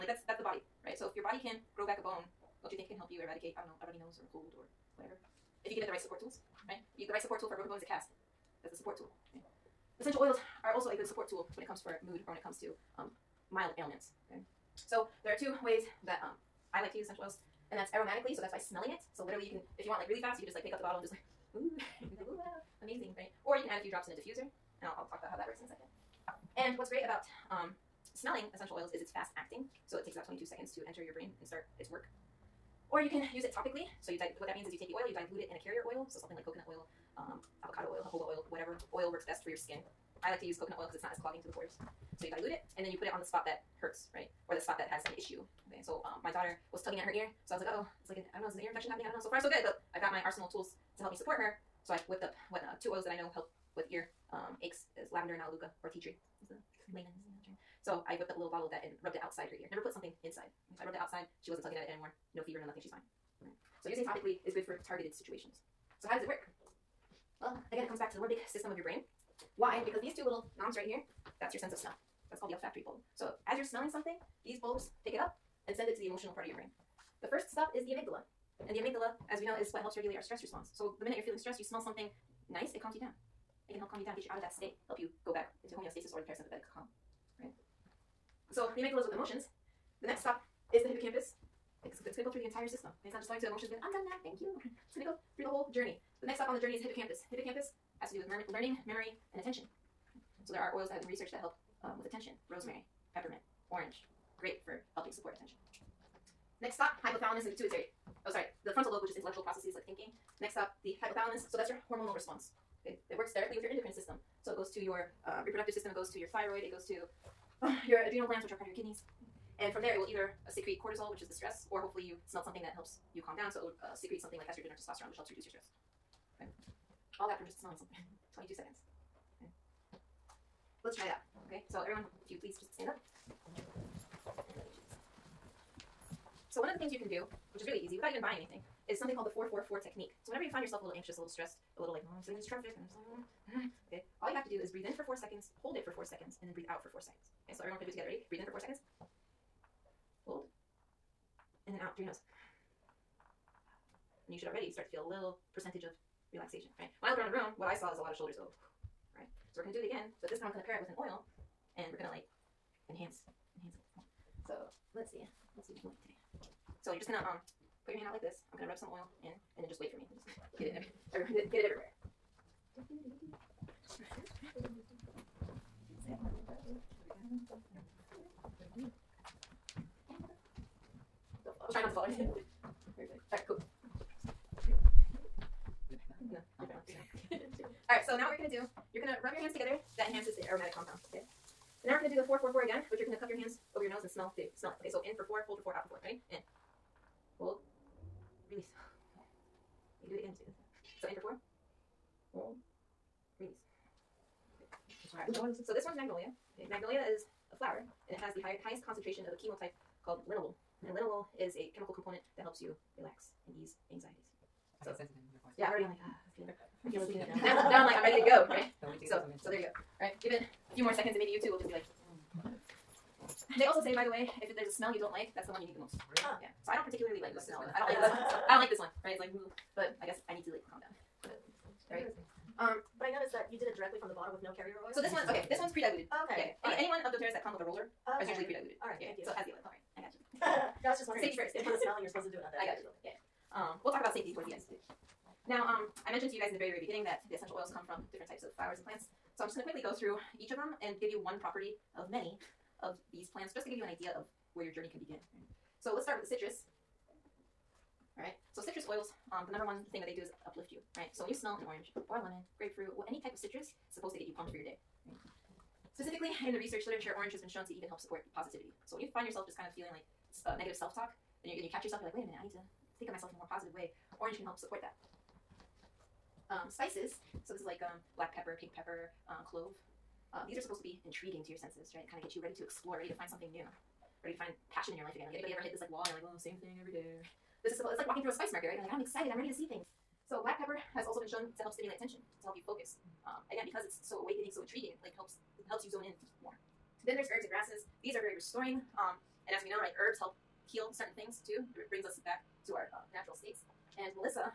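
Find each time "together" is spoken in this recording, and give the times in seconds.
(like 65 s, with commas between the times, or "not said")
147 s, 189 s.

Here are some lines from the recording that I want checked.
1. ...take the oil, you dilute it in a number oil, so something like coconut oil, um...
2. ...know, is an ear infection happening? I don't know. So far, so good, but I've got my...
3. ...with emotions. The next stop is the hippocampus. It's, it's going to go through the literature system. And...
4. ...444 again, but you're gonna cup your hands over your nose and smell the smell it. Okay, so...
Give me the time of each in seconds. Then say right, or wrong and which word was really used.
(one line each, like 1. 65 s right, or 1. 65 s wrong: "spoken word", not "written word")
1. 34 s wrong: "carrier", not "number"
2. 48 s right
3. 89 s wrong: "entire", not "literature"
4. 192 s right.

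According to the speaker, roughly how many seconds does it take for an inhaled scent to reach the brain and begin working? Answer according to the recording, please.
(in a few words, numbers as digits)
22 seconds.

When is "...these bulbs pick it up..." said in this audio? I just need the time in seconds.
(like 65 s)
74 s.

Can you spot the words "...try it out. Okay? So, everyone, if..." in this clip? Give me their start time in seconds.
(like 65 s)
130 s.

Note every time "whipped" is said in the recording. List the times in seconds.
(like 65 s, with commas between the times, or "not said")
52 s, 58 s.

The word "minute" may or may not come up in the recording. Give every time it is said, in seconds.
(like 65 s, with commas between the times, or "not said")
81 s, 272 s.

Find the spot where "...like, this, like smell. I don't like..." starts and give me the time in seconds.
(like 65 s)
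227 s.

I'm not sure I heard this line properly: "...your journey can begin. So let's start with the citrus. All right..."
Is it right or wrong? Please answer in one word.
right.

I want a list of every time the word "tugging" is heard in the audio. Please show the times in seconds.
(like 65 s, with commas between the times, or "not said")
46 s, 61 s.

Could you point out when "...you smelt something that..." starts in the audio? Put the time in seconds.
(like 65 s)
122 s.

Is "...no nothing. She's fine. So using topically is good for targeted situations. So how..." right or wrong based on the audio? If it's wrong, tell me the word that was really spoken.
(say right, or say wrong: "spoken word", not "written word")
right.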